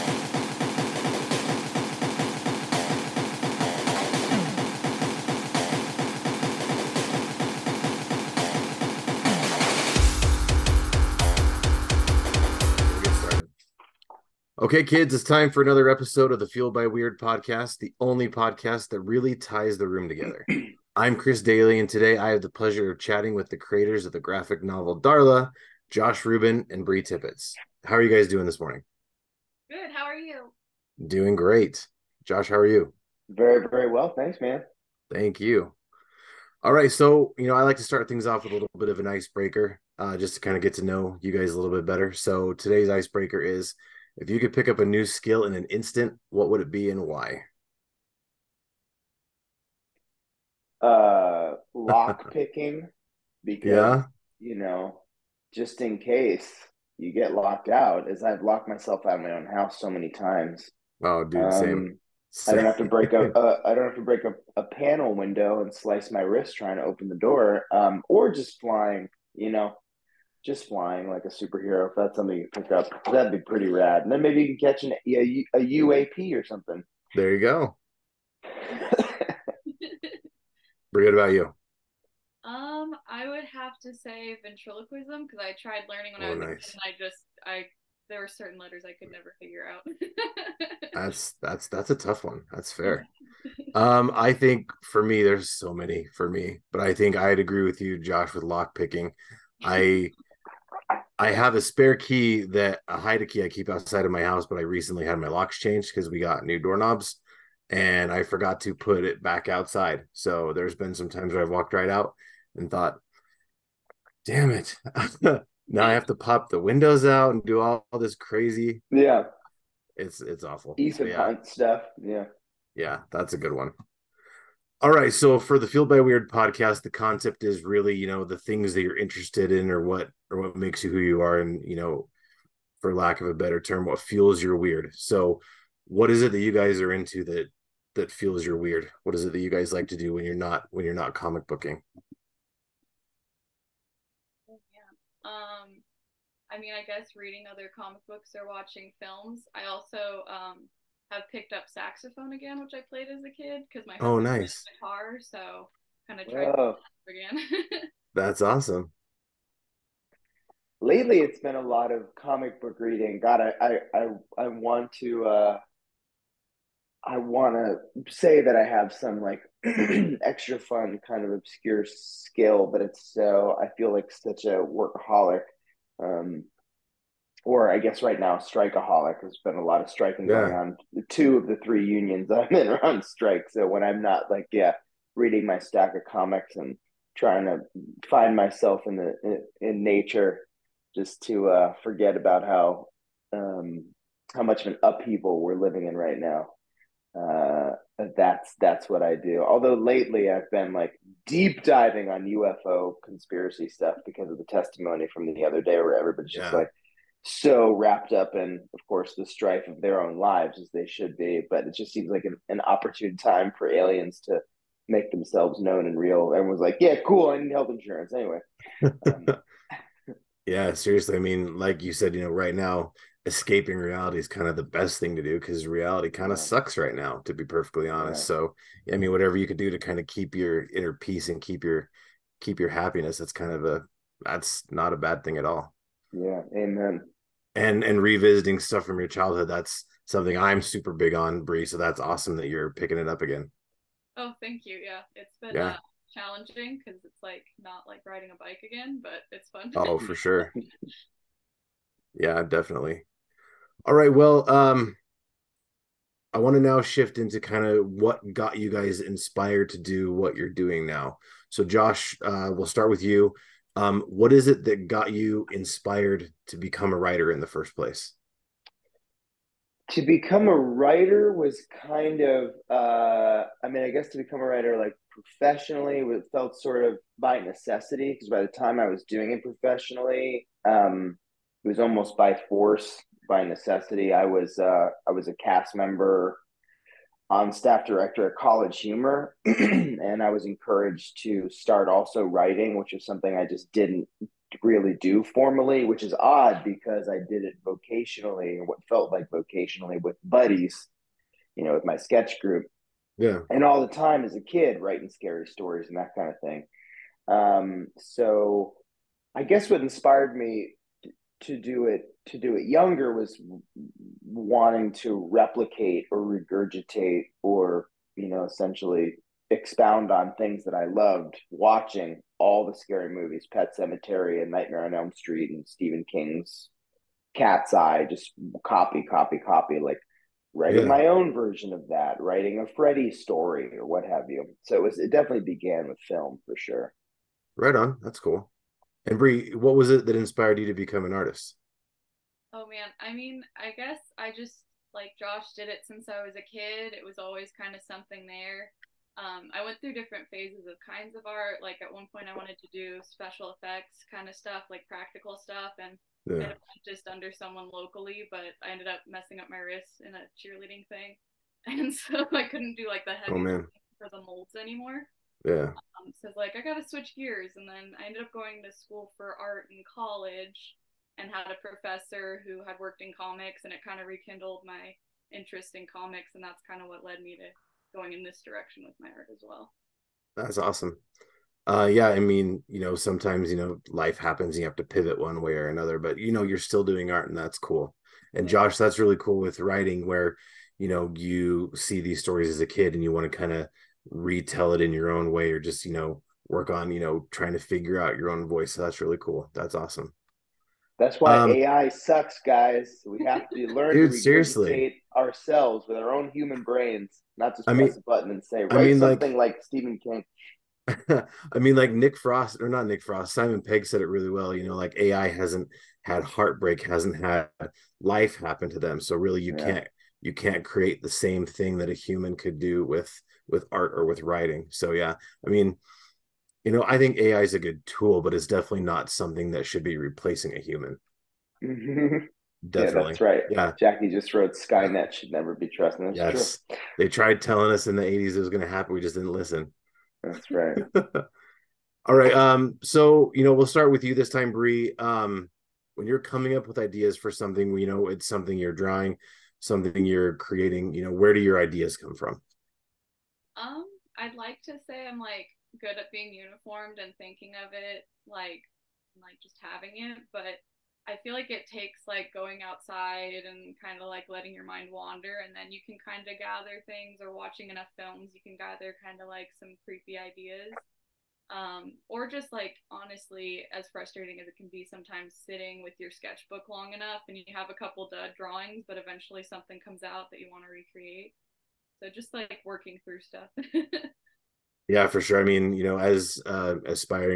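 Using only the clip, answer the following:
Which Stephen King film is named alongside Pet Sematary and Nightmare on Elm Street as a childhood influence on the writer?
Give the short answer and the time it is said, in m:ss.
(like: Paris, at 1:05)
Cat's Eye, at 5:27.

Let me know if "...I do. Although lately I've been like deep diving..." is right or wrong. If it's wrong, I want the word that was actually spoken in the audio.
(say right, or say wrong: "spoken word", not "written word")
right.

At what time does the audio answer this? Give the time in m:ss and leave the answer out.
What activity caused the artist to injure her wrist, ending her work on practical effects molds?
6:00.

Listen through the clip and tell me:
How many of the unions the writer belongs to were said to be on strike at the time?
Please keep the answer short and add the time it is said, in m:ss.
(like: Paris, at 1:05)
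2, at 3:01.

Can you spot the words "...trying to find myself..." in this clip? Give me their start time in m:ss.
3:07.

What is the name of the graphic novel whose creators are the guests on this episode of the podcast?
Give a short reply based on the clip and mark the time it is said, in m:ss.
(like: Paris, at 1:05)
Darla, at 0:24.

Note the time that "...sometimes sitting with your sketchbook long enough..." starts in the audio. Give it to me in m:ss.
7:54.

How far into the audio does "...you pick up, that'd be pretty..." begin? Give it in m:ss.
1:12.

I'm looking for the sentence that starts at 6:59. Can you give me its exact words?
can't you can't create the same thing that a human could do with with art or with writing.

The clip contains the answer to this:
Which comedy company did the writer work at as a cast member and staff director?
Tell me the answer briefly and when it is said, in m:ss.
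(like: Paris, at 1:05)
College Humor, at 4:48.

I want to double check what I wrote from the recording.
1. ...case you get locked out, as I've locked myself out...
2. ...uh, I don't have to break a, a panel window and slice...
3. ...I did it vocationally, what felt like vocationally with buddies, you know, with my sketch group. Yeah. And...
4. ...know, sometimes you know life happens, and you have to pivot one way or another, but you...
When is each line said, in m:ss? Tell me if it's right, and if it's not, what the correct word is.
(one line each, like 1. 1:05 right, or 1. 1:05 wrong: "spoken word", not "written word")
1. 0:55 right
2. 1:03 right
3. 4:57 right
4. 6:22 right.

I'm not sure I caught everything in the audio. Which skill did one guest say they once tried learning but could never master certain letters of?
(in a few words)
Ventriloquism.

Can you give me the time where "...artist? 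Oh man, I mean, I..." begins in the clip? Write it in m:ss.
5:41.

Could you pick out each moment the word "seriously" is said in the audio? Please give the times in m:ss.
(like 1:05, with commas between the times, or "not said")
3:40, 6:44.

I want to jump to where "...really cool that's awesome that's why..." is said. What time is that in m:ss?
6:39.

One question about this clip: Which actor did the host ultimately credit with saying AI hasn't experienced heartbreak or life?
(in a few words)
Simon Pegg.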